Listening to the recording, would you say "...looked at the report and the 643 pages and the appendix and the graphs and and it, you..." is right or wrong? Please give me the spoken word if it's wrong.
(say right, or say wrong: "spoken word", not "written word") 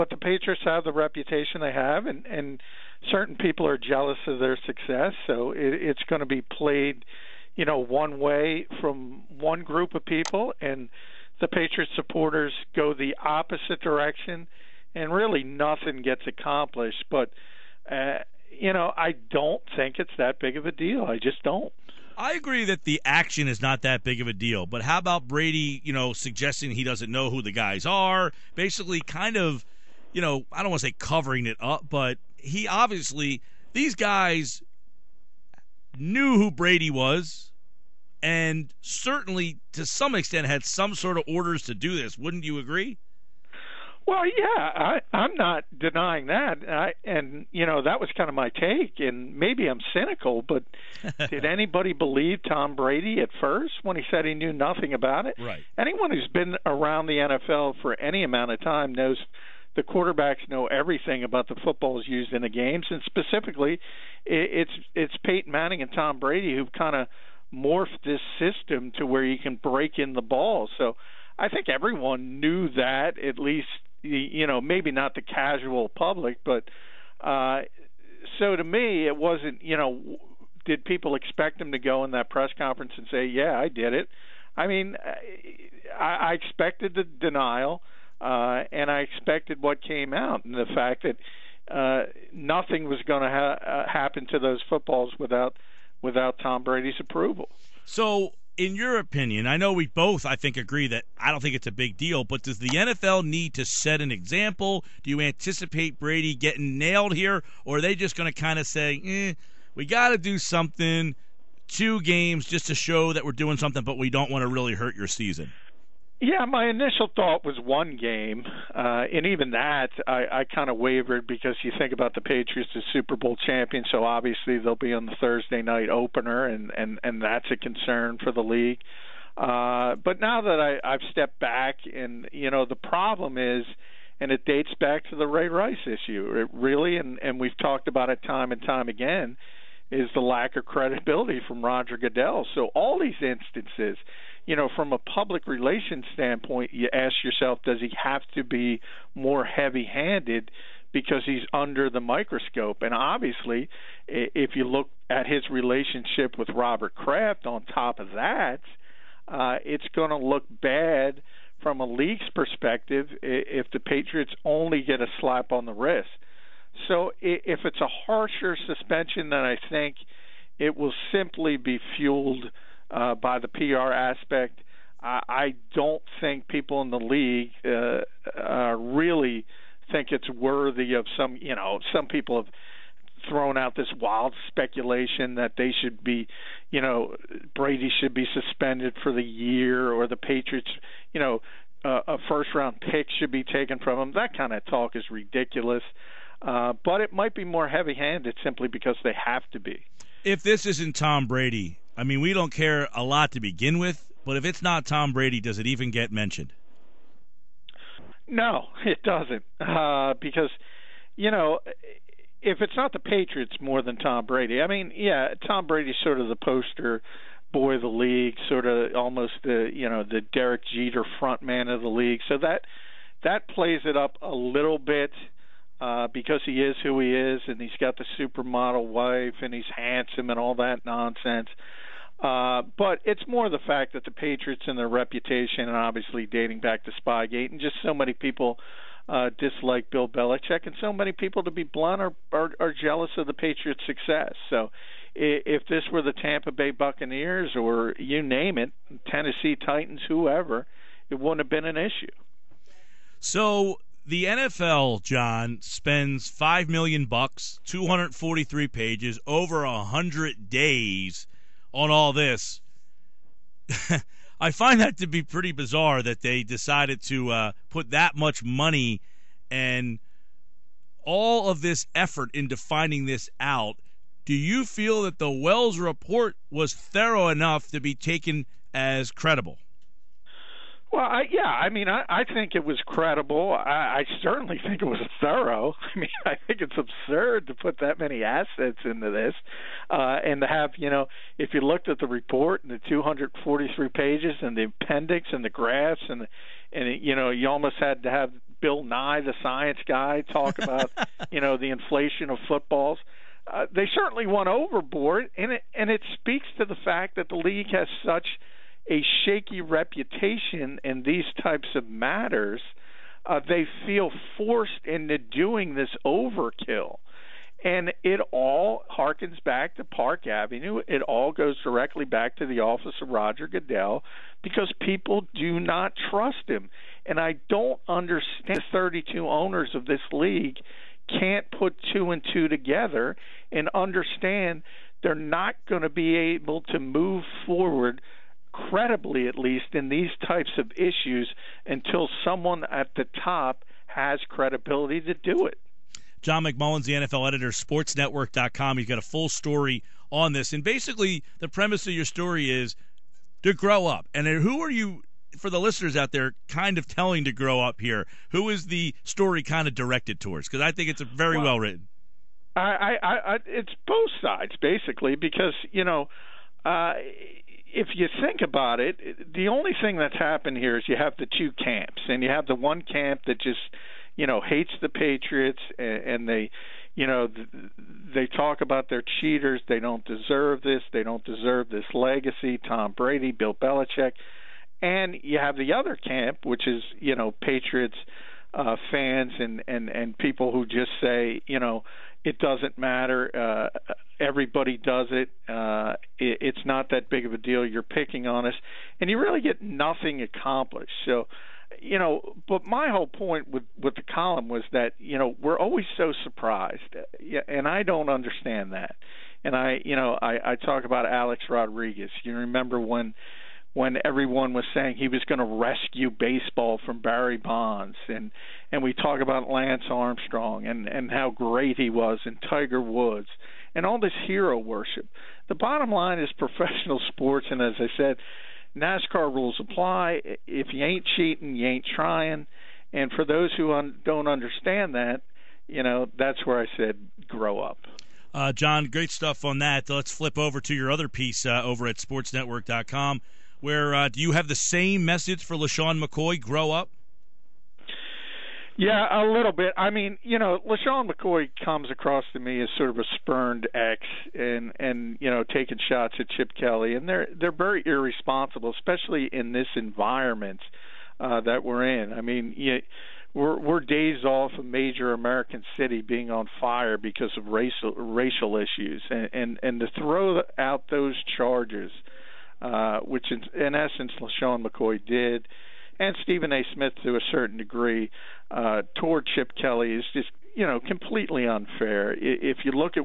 wrong: "243", not "643".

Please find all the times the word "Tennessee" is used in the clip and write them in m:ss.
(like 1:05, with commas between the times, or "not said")
4:09.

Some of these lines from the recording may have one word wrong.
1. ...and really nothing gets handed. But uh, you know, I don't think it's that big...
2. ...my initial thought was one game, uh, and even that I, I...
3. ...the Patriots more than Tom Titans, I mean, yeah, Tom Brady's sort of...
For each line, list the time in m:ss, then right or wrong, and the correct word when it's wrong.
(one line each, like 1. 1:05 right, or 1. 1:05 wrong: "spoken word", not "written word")
1. 0:14 wrong: "accomplished", not "handed"
2. 1:56 right
3. 3:32 wrong: "Brady", not "Titans".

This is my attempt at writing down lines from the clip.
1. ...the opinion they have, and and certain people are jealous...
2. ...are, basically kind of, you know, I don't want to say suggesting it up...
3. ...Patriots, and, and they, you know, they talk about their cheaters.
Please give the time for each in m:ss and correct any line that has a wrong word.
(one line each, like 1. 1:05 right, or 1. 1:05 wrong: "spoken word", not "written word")
1. 0:00 wrong: "reputation", not "opinion"
2. 0:27 wrong: "covering", not "suggesting"
3. 6:14 right.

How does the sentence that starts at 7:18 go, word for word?
Uh, John, great stuff on that.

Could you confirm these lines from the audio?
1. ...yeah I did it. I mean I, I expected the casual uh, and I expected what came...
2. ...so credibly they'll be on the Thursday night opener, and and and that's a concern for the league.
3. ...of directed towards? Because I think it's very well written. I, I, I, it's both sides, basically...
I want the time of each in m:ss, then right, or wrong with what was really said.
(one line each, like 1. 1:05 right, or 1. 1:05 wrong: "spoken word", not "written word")
1. 1:23 wrong: "denial", not "casual"
2. 2:03 wrong: "obviously", not "credibly"
3. 5:59 right.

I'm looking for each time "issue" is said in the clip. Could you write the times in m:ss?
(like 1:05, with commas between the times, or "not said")
2:15, 4:11, 5:40, 7:48.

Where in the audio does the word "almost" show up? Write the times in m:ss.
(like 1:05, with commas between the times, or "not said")
3:38, 4:57.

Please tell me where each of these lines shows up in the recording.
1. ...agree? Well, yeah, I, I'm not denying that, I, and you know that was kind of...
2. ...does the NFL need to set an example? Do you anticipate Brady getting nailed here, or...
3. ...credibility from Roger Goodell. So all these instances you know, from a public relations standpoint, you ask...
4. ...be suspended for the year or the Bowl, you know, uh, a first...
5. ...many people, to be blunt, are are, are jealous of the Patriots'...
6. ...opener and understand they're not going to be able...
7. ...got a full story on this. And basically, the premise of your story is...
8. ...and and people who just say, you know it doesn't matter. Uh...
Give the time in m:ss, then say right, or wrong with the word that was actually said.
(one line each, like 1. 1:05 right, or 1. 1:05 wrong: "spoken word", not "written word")
1. 0:42 right
2. 1:42 right
3. 2:20 right
4. 3:08 wrong: "Patriots", not "Bowl"
5. 4:00 right
6. 5:32 wrong: "together", not "opener"
7. 5:48 right
8. 6:29 right.